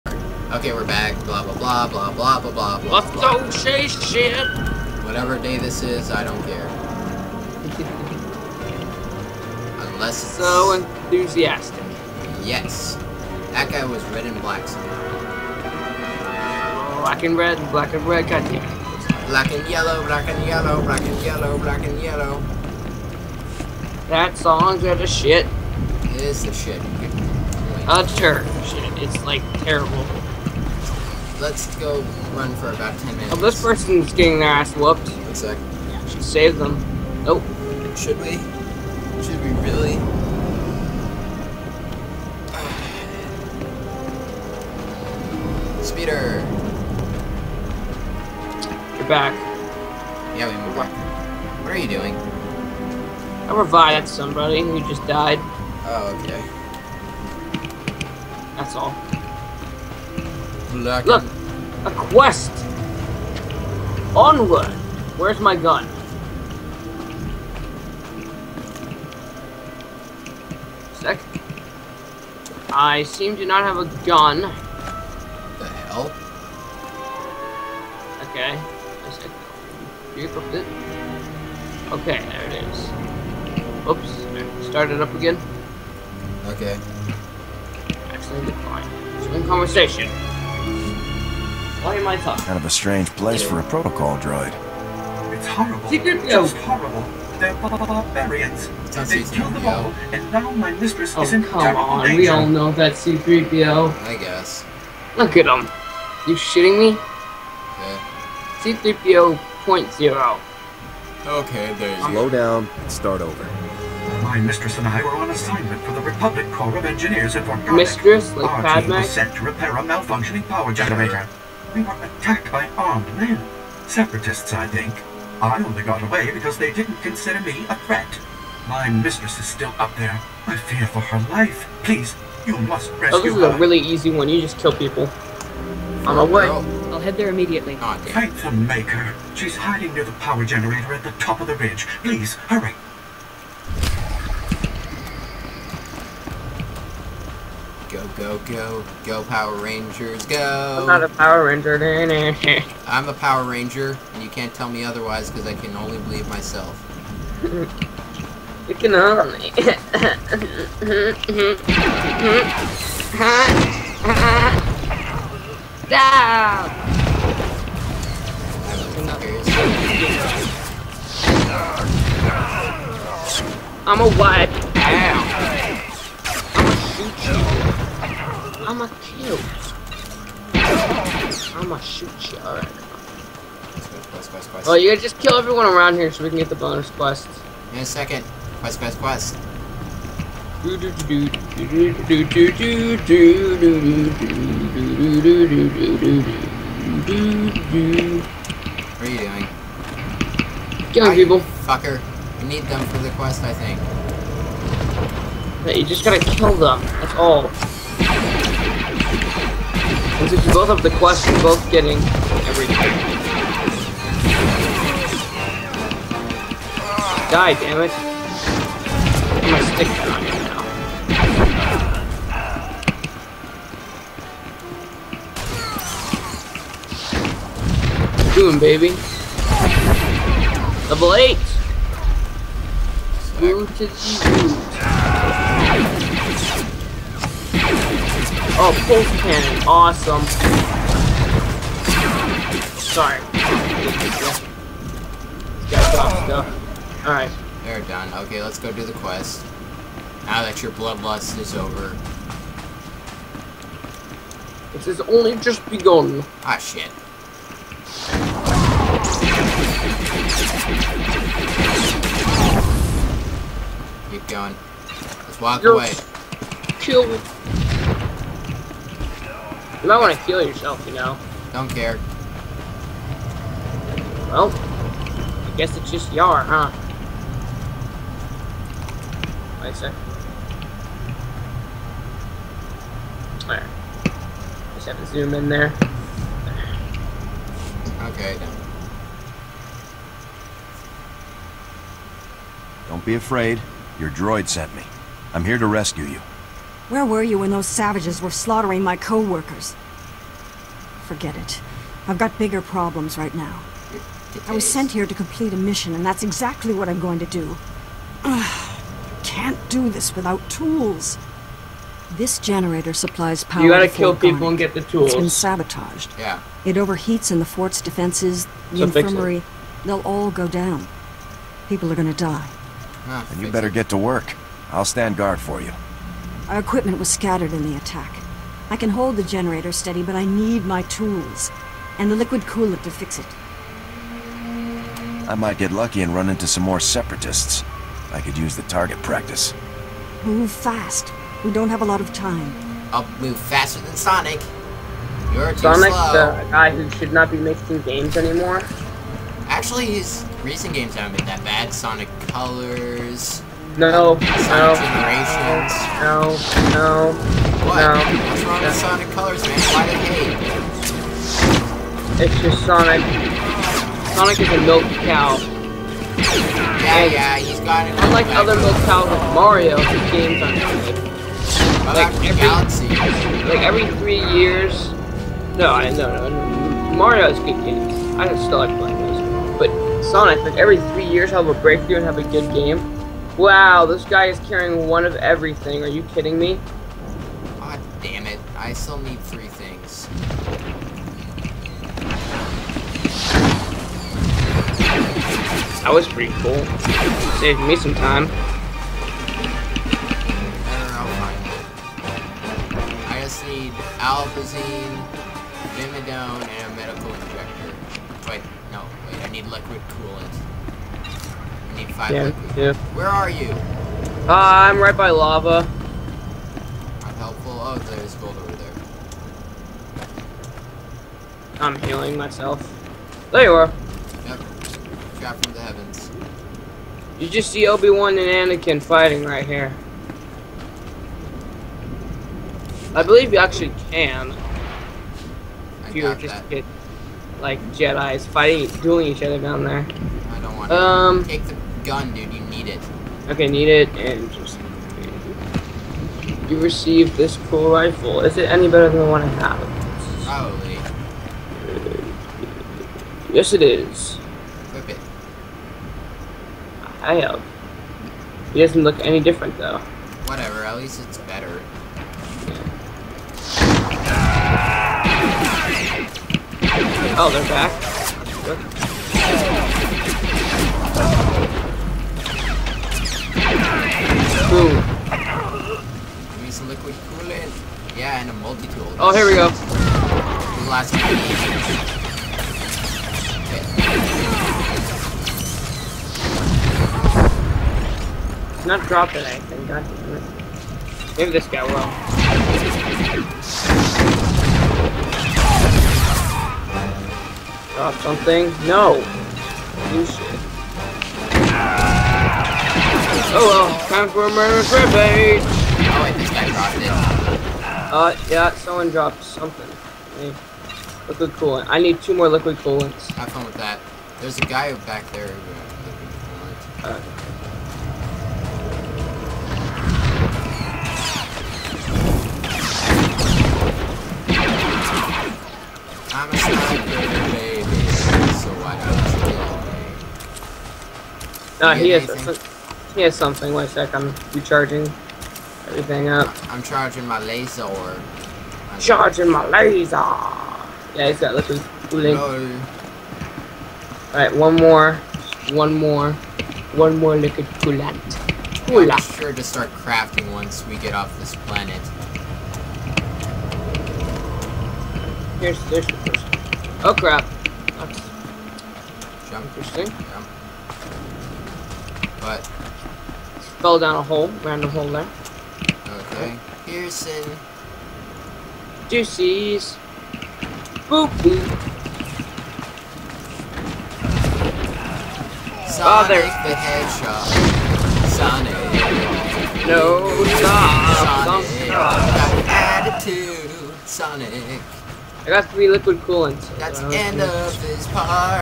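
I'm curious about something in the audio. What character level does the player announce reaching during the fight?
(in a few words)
8.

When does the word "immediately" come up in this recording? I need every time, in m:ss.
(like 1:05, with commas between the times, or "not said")
2:17.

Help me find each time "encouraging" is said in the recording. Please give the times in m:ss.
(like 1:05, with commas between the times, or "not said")
not said.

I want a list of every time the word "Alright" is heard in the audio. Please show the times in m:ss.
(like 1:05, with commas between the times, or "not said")
3:02, 4:07, 9:04.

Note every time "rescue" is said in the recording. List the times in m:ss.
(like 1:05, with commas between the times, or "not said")
2:12, 4:55.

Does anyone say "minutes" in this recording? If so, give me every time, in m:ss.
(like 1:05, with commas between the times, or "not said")
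0:33.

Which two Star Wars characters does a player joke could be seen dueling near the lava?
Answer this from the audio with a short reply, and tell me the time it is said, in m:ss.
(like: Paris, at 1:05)
Obi-Wan and Anakin, at 7:07.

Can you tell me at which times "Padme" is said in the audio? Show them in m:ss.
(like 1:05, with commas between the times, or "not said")
1:58.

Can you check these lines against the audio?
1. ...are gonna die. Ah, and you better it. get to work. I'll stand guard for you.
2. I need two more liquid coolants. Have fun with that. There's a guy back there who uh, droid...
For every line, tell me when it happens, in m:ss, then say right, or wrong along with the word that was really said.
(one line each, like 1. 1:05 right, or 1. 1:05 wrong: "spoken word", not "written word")
1. 5:21 right
2. 8:31 wrong: "liquid", not "droid".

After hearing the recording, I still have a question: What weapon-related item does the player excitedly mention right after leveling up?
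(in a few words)
Pulse cannon.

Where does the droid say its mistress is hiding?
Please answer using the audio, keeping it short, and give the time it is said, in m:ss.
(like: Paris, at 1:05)
Near the power generator, at 2:19.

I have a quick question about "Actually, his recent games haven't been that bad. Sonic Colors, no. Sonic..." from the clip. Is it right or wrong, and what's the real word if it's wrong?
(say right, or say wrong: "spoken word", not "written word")
right.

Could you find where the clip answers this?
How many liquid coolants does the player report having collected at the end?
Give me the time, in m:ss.
9:45.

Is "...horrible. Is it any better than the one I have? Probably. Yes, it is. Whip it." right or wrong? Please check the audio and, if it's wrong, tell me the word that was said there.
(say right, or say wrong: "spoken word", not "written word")
wrong: "rifle", not "horrible".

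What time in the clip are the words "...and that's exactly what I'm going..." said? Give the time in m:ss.
5:05.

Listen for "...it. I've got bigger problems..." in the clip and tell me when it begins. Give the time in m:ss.
5:01.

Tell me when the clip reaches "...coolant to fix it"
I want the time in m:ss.
5:32.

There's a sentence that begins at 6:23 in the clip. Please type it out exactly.
Wow, this guy is carrying one of everything.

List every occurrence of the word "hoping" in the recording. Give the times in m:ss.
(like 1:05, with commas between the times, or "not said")
not said.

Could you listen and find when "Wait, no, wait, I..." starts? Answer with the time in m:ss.
6:48.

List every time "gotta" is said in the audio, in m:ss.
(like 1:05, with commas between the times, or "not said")
3:04, 3:26, 5:13.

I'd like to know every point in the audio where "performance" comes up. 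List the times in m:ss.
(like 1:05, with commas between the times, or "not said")
not said.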